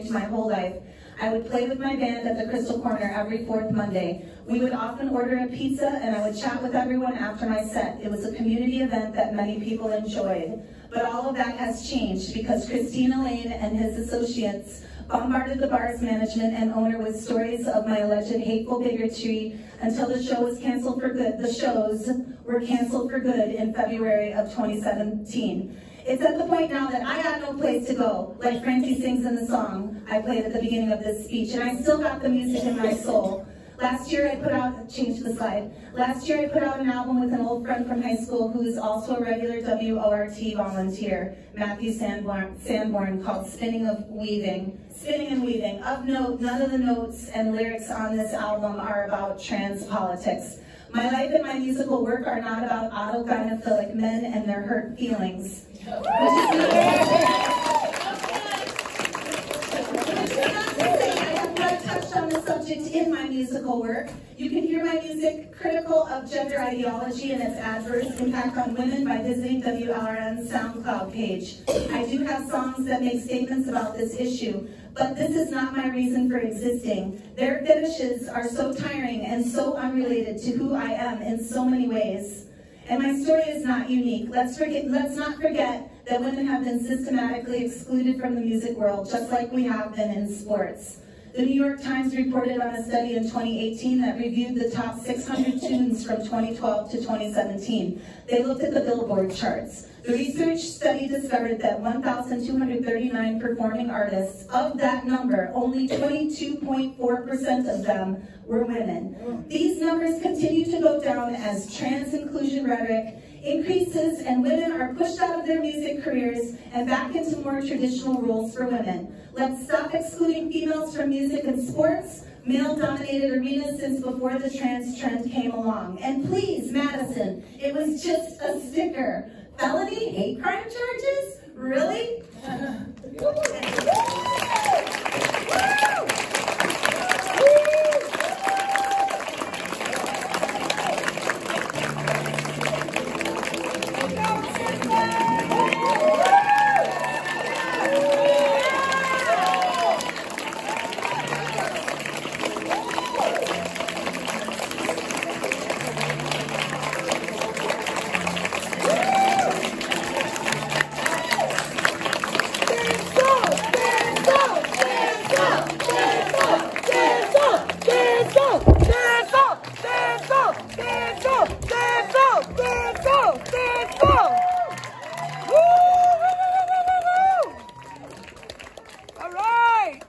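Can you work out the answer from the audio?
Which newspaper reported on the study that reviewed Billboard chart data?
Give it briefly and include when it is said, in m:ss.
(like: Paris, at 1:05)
The New York Times, at 1:31.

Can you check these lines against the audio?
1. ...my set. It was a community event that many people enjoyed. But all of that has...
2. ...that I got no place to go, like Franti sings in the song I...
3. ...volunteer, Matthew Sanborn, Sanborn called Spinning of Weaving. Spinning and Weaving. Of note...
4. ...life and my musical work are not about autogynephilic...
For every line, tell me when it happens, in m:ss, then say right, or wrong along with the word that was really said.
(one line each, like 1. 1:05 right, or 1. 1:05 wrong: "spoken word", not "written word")
1. 0:07 right
2. 0:26 right
3. 0:40 right
4. 0:51 right.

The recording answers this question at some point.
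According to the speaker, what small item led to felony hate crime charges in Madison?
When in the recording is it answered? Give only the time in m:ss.
2:08.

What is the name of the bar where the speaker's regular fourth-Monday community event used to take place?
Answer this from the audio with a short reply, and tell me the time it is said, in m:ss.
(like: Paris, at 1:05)
Crystal Corner, at 0:02.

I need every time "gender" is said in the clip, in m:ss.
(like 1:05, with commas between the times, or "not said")
1:06.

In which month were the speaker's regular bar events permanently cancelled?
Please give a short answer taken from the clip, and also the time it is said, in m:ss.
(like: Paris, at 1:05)
February, at 0:23.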